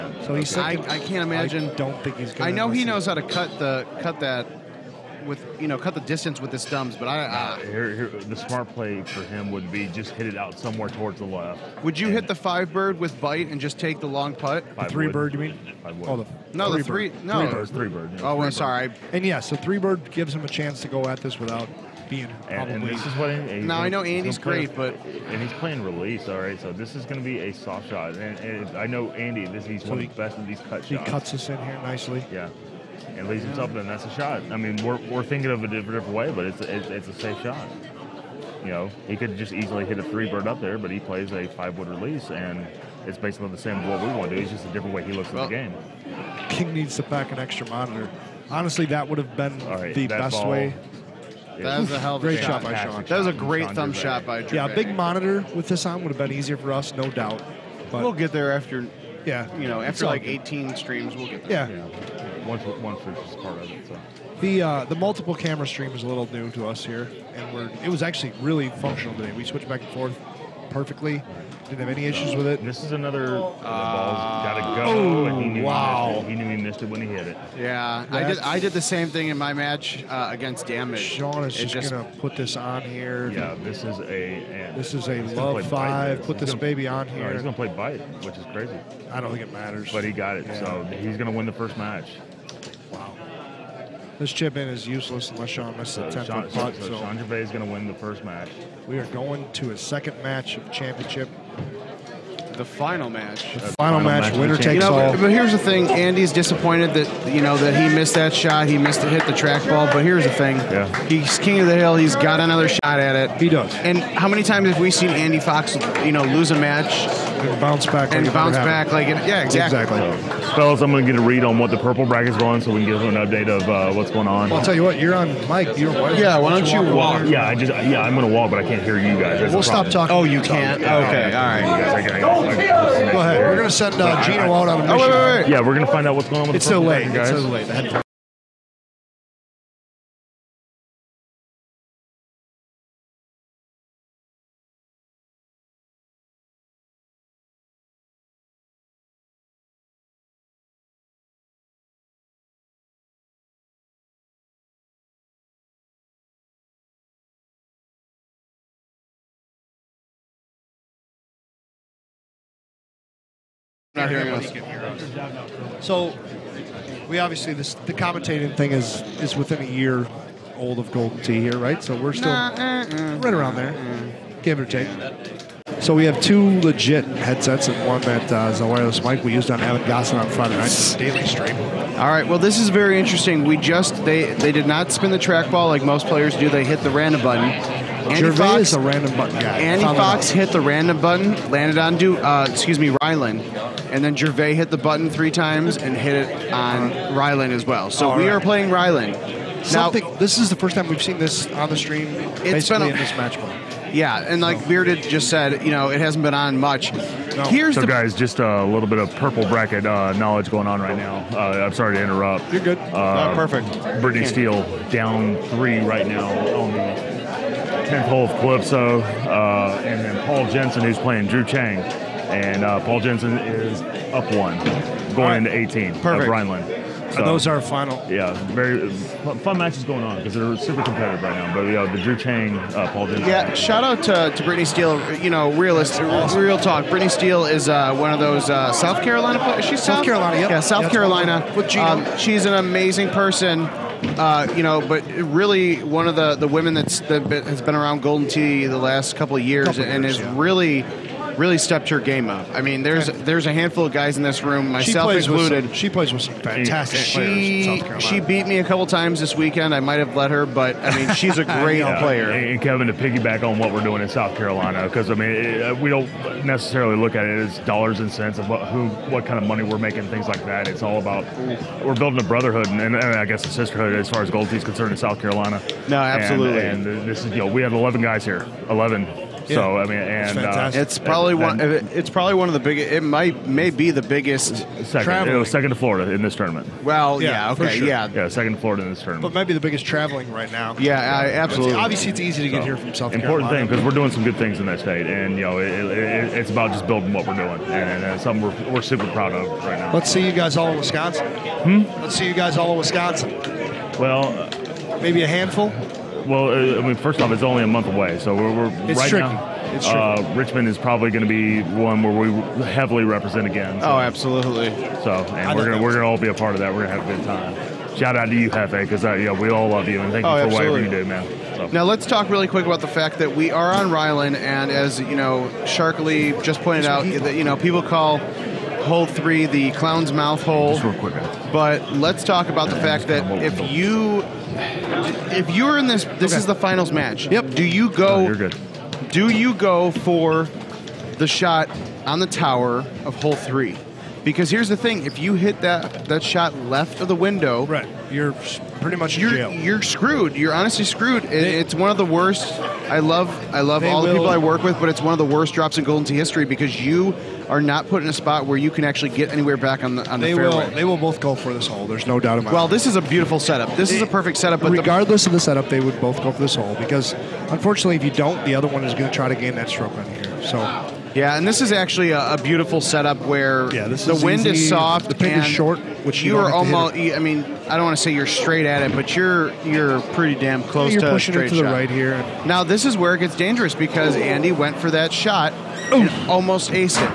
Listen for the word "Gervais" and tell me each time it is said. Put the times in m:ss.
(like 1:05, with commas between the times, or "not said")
1:37, 3:08, 3:14.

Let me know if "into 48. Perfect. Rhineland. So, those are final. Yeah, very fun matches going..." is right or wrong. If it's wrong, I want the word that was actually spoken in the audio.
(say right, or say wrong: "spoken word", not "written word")
wrong: "18", not "48".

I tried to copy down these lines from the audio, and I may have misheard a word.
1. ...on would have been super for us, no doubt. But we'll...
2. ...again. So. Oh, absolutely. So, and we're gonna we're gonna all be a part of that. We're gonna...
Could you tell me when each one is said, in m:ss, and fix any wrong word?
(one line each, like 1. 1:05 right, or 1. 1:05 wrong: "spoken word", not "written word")
1. 0:55 wrong: "easier", not "super"
2. 5:13 right.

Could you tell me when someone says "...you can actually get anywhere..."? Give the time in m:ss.
5:58.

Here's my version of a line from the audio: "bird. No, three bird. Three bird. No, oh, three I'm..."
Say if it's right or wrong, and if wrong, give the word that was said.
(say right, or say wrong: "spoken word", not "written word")
right.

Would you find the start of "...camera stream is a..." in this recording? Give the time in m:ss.
1:05.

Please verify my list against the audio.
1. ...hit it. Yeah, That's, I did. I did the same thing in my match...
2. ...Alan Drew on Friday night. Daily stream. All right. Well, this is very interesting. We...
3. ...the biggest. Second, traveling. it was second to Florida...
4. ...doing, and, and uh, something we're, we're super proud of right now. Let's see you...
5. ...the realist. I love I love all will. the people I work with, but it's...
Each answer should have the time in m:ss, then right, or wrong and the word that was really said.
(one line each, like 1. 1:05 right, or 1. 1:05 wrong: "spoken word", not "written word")
1. 1:17 right
2. 2:59 wrong: "Gossin", not "Drew"
3. 4:43 right
4. 4:57 right
5. 5:51 wrong: "worst", not "realist".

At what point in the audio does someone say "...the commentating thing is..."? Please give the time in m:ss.
2:47.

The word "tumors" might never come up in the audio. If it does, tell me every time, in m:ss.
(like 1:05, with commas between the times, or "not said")
not said.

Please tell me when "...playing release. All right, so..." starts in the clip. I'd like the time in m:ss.
0:25.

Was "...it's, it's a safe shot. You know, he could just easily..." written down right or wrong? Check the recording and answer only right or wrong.
right.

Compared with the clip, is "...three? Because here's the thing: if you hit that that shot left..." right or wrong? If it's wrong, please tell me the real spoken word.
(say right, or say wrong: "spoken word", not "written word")
right.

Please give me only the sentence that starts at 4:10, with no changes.
really really stepped her game up.